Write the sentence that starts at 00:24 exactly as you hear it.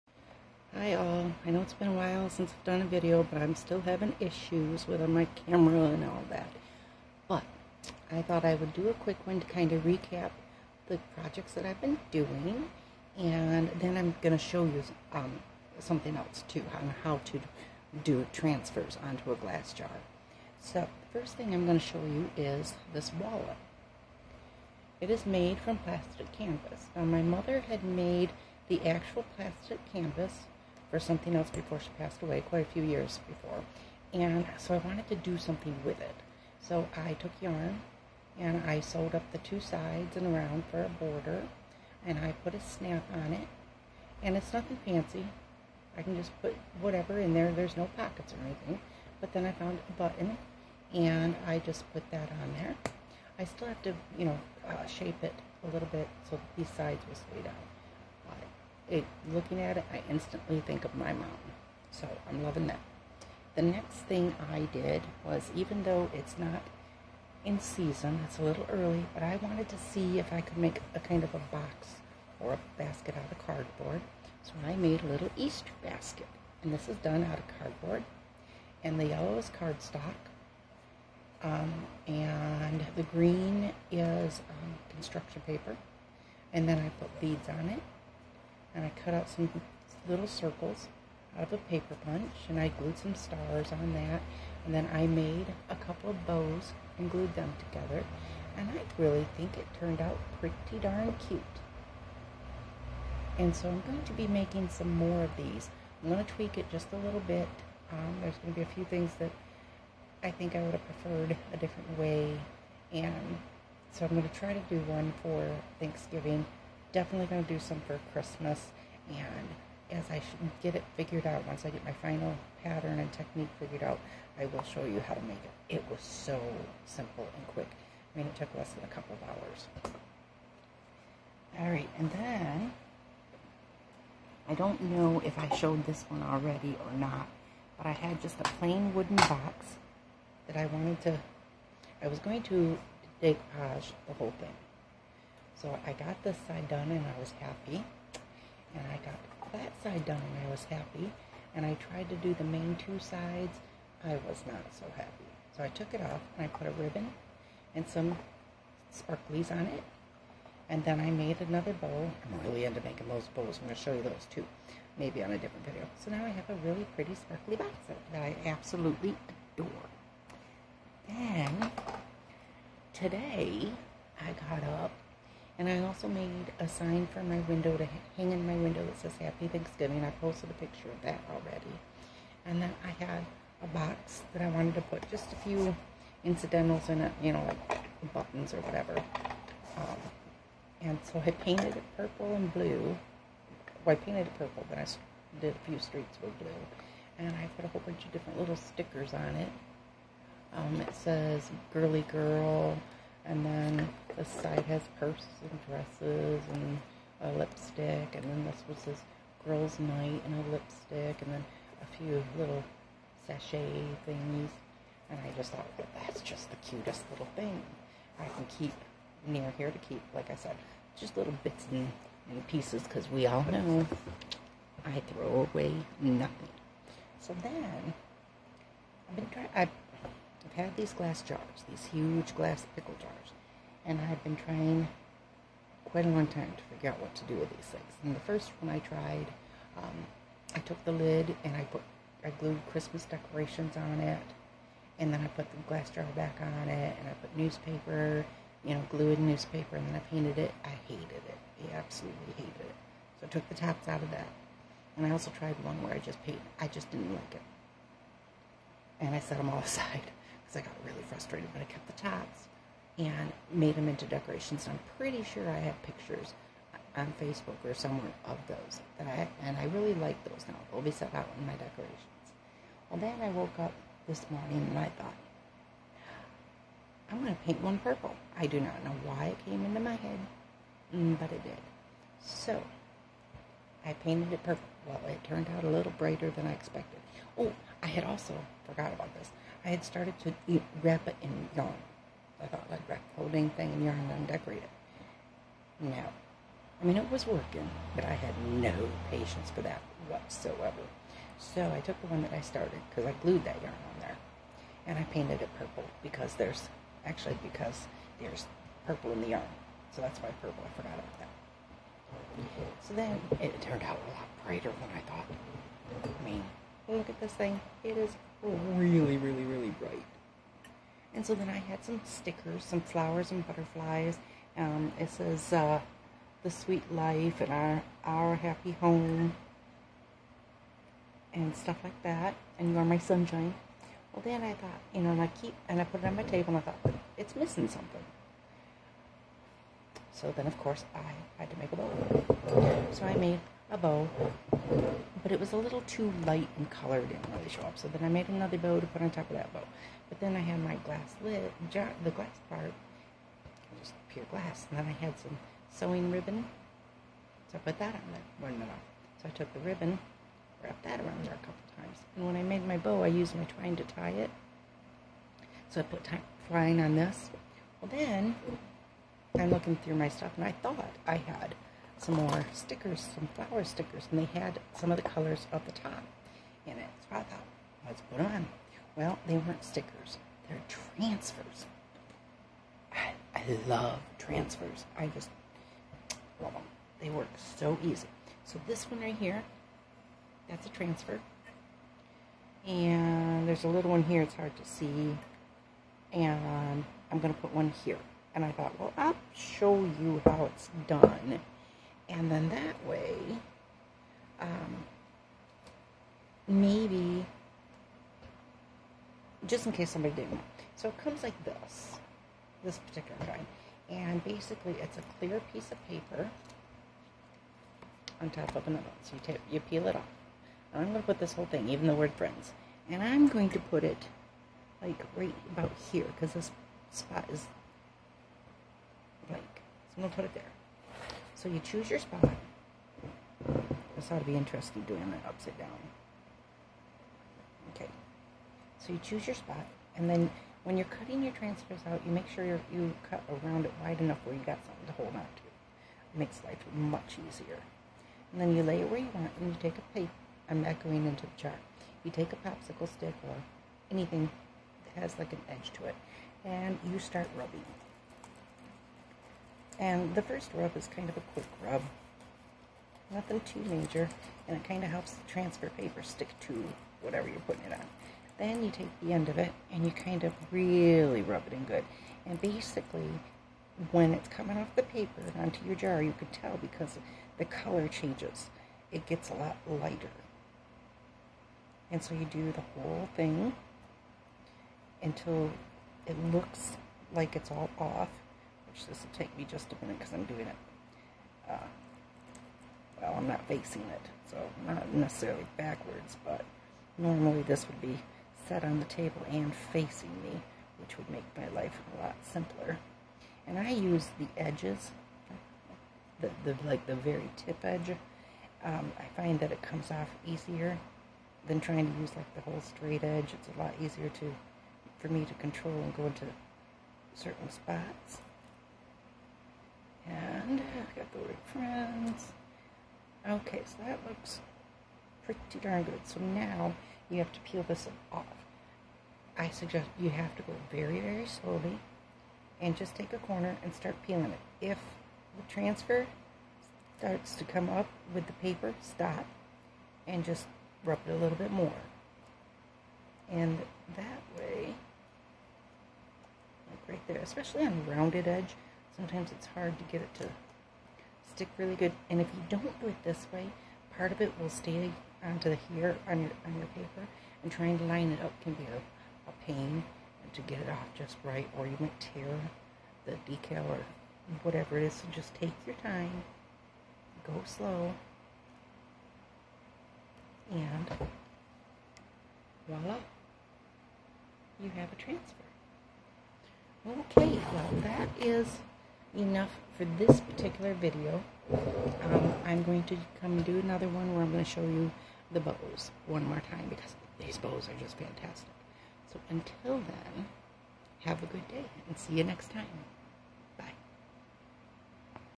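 It is made from plastic canvas.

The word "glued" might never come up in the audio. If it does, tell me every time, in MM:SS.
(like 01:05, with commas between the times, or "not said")
01:32, 01:37, 04:02, 04:08, 05:03.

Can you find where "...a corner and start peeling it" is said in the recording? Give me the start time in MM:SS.
08:53.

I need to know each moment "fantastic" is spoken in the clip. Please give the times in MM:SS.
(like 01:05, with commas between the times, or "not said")
09:47.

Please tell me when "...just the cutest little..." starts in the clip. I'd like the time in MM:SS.
03:36.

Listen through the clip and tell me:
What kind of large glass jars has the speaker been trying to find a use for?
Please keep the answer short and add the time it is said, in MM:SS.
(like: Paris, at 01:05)
Pickle jars, at 03:52.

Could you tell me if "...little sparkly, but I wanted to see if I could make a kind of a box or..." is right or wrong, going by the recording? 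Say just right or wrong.
wrong.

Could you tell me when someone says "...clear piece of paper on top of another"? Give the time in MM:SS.
06:55.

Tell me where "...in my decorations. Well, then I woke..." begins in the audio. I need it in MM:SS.
04:31.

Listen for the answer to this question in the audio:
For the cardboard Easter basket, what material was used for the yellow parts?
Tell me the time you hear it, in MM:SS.
01:19.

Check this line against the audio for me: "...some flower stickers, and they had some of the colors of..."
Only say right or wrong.
right.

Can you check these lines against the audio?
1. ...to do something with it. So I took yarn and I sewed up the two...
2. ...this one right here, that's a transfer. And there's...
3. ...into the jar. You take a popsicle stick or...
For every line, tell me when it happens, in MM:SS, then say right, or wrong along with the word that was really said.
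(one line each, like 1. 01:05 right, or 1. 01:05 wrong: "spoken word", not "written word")
1. 00:35 right
2. 06:28 right
3. 07:31 right.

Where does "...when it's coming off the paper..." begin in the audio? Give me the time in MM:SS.
07:53.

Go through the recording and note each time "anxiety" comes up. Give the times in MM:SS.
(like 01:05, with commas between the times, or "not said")
not said.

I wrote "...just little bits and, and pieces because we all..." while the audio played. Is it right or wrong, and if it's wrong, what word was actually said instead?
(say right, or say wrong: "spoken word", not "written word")
right.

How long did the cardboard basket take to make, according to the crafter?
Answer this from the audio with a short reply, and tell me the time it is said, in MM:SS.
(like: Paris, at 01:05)
Less than a couple of hours, at 02:08.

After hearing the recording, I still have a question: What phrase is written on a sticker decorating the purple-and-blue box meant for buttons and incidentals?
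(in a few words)
Girly girl.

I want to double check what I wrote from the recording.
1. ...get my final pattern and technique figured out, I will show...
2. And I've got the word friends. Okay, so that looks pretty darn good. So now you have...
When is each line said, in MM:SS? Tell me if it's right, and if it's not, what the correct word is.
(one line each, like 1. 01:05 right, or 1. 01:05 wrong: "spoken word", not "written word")
1. 02:01 right
2. 08:40 right.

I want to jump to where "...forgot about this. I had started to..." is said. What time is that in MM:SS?
04:48.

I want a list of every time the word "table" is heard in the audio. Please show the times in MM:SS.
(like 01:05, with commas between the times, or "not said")
05:36, 08:18.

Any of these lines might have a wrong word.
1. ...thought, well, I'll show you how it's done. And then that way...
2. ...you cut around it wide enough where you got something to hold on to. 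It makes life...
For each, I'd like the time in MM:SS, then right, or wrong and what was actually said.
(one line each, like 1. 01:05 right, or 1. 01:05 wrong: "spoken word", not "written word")
1. 06:38 right
2. 07:22 right.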